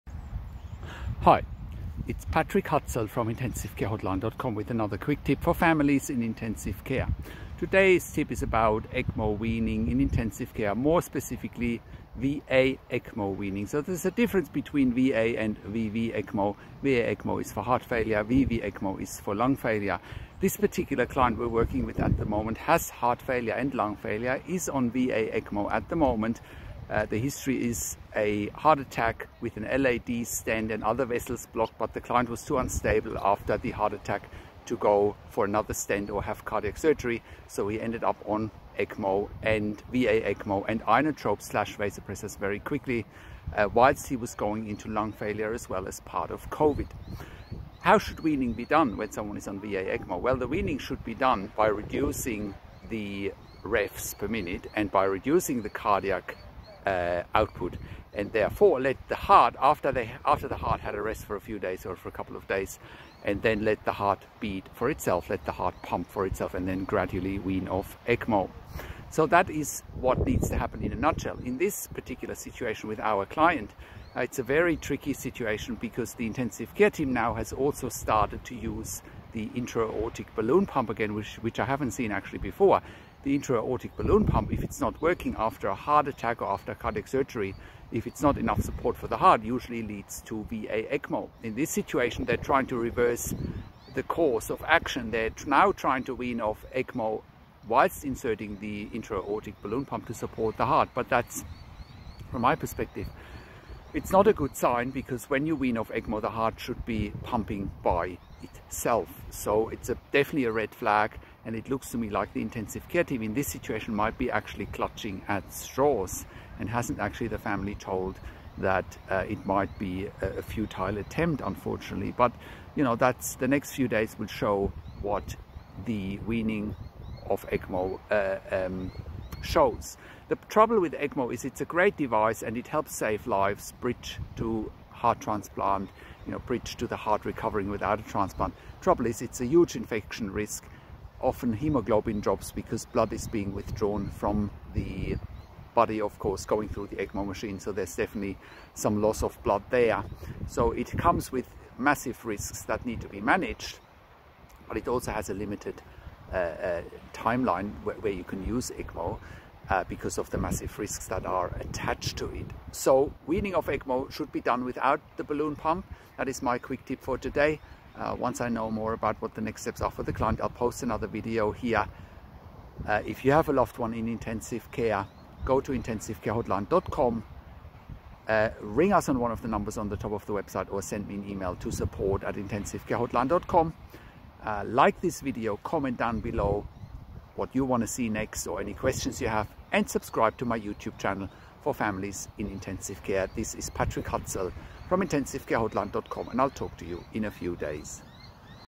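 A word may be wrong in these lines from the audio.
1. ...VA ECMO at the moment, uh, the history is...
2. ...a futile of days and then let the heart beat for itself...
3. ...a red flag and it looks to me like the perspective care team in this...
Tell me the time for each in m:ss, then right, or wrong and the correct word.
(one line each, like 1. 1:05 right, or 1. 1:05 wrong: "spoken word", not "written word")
1. 0:24 right
2. 1:02 wrong: "couple", not "futile"
3. 1:50 wrong: "intensive", not "perspective".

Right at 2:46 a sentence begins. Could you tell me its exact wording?
That is my quick tip for today.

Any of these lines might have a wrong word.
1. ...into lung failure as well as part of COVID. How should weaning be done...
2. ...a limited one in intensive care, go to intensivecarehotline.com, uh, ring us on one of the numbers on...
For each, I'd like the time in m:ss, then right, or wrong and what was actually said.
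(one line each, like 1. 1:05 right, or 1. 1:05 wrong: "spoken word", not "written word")
1. 0:44 right
2. 2:53 wrong: "loved", not "limited".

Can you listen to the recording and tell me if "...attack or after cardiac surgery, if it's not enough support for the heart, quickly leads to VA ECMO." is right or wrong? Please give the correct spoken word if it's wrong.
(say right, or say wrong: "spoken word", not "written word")
wrong: "usually", not "quickly".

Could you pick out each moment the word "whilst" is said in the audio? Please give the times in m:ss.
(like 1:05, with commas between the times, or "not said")
0:43, 1:37.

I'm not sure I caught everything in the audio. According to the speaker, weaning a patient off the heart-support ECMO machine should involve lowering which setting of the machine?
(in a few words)
revs per minute.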